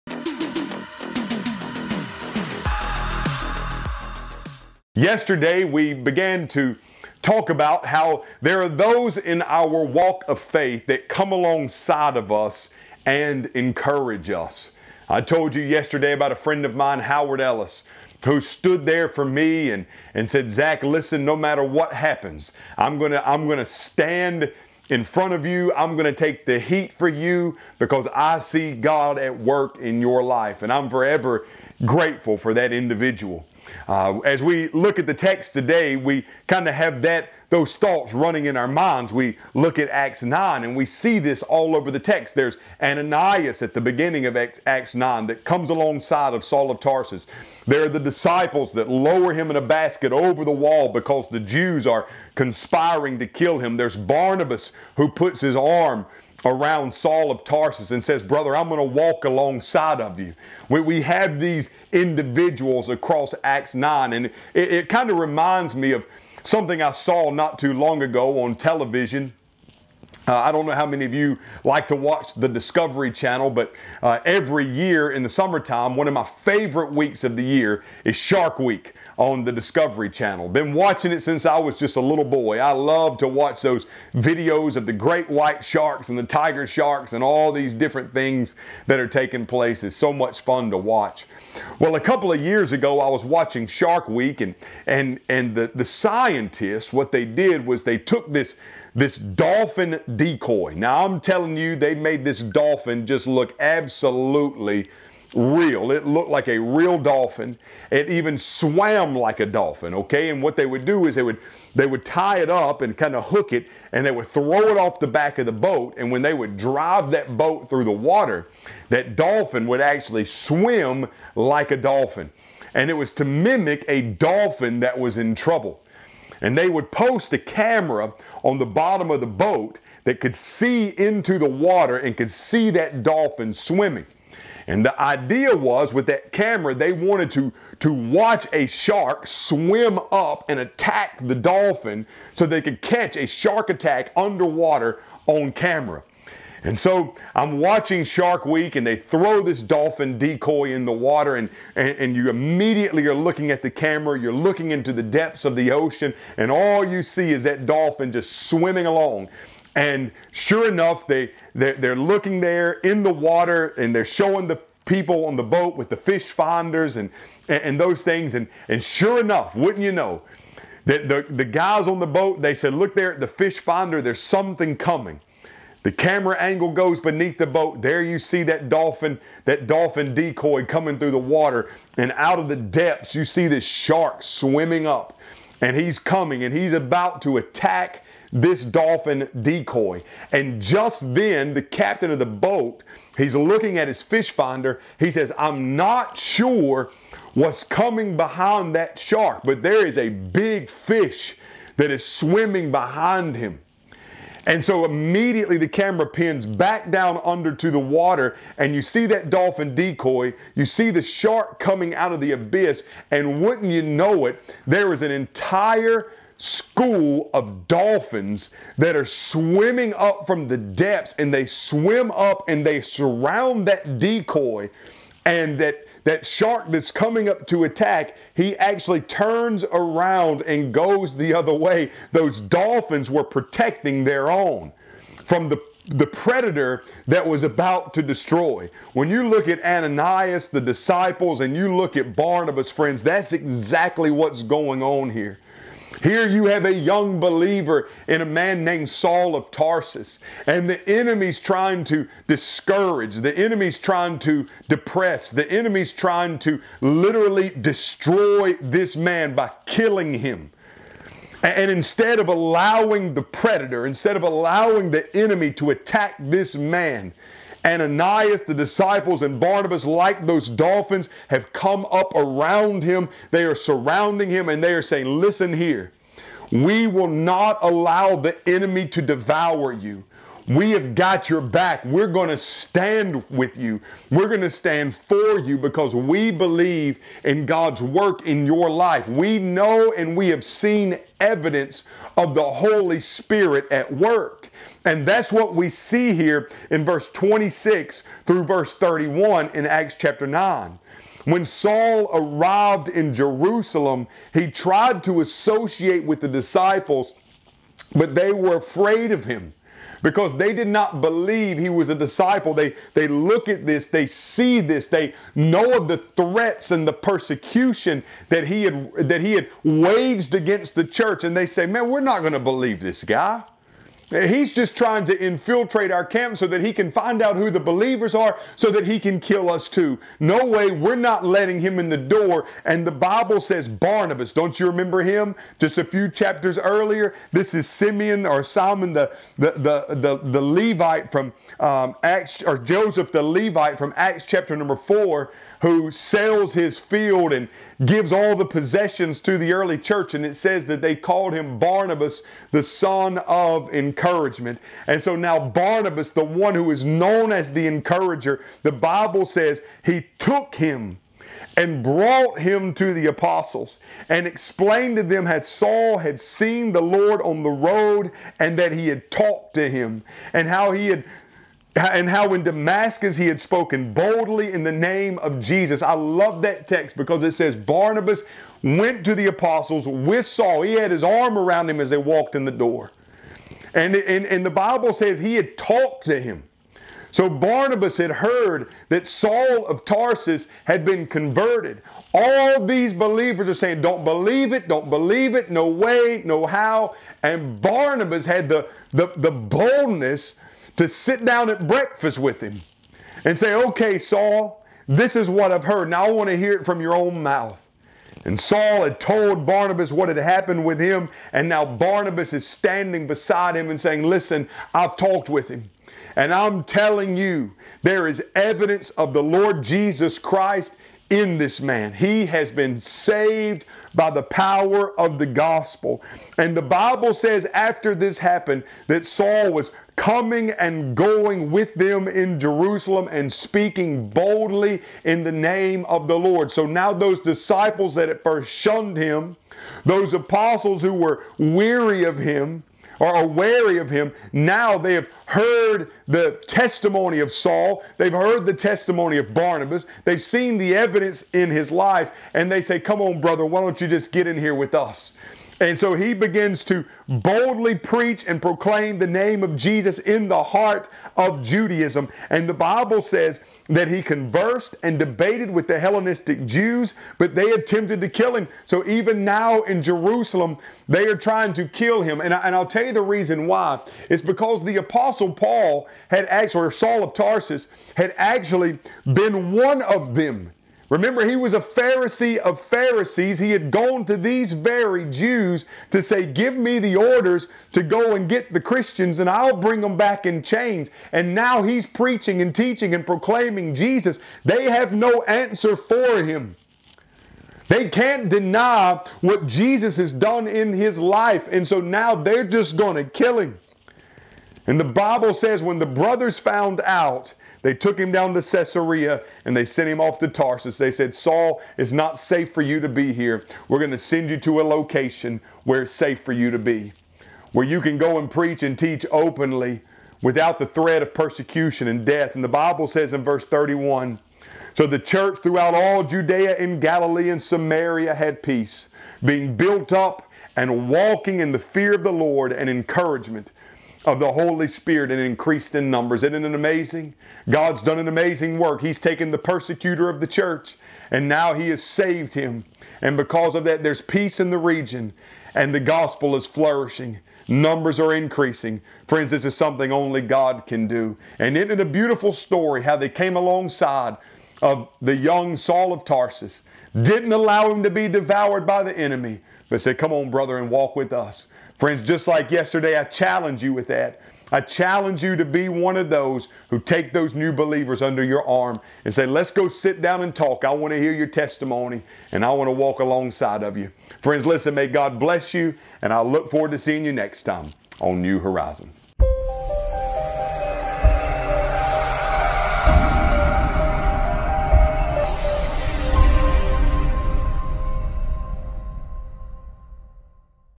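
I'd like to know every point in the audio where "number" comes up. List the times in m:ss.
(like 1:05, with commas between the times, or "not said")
5:44, 8:55, 9:07.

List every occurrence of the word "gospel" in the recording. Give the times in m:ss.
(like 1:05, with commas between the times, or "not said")
7:05, 9:05.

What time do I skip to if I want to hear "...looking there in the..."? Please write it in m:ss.
2:41.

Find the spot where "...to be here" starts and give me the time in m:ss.
8:32.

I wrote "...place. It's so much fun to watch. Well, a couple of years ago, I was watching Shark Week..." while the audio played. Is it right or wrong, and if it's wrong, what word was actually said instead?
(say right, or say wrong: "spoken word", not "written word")
right.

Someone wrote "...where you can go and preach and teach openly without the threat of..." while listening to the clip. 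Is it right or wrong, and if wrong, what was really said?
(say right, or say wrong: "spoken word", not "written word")
right.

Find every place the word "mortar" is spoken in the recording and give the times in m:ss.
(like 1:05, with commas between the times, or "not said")
not said.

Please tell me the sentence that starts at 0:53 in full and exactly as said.
There's Barnabas who puts his arm around Saul of Tarsus and says, Brother, I'm going to walk alongside of you.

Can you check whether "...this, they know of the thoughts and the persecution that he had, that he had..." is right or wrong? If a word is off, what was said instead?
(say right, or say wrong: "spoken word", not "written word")
wrong: "threats", not "thoughts".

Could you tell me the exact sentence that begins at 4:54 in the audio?
And that's what we see here in verse 26 through verse 31 in Acts chapter 9.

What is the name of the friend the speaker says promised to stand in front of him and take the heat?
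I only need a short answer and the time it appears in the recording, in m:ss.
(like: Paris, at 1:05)
Howard Ellis, at 0:16.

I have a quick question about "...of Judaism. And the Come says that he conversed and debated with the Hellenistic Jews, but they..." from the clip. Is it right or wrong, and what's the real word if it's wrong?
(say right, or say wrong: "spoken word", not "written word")
wrong: "Bible", not "Come".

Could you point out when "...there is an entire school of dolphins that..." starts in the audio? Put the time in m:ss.
3:34.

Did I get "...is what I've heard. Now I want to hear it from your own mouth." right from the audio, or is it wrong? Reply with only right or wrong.
right.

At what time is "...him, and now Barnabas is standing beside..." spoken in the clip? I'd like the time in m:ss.
6:50.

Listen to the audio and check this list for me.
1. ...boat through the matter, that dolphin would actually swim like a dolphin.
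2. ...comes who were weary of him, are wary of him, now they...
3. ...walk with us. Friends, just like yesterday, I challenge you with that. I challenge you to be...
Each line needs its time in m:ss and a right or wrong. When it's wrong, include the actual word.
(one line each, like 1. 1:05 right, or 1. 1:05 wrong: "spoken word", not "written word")
1. 1:57 wrong: "water", not "matter"
2. 7:20 wrong: "apostles", not "comes"
3. 9:20 right.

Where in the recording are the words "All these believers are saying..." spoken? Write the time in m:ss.
6:32.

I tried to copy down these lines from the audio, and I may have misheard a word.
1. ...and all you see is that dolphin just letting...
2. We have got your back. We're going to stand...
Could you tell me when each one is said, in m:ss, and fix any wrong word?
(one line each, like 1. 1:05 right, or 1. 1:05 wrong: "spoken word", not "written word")
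1. 2:36 wrong: "swimming", not "letting"
2. 4:40 right.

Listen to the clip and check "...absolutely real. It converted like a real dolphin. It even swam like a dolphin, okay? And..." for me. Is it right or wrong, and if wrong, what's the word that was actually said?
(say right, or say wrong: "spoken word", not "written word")
wrong: "looked", not "converted".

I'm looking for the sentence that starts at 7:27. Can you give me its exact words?
They've heard the testimony of Barnabas.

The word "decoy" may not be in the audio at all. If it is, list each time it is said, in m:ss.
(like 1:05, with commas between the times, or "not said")
1:40, 2:30, 3:00, 3:09, 3:29, 3:43.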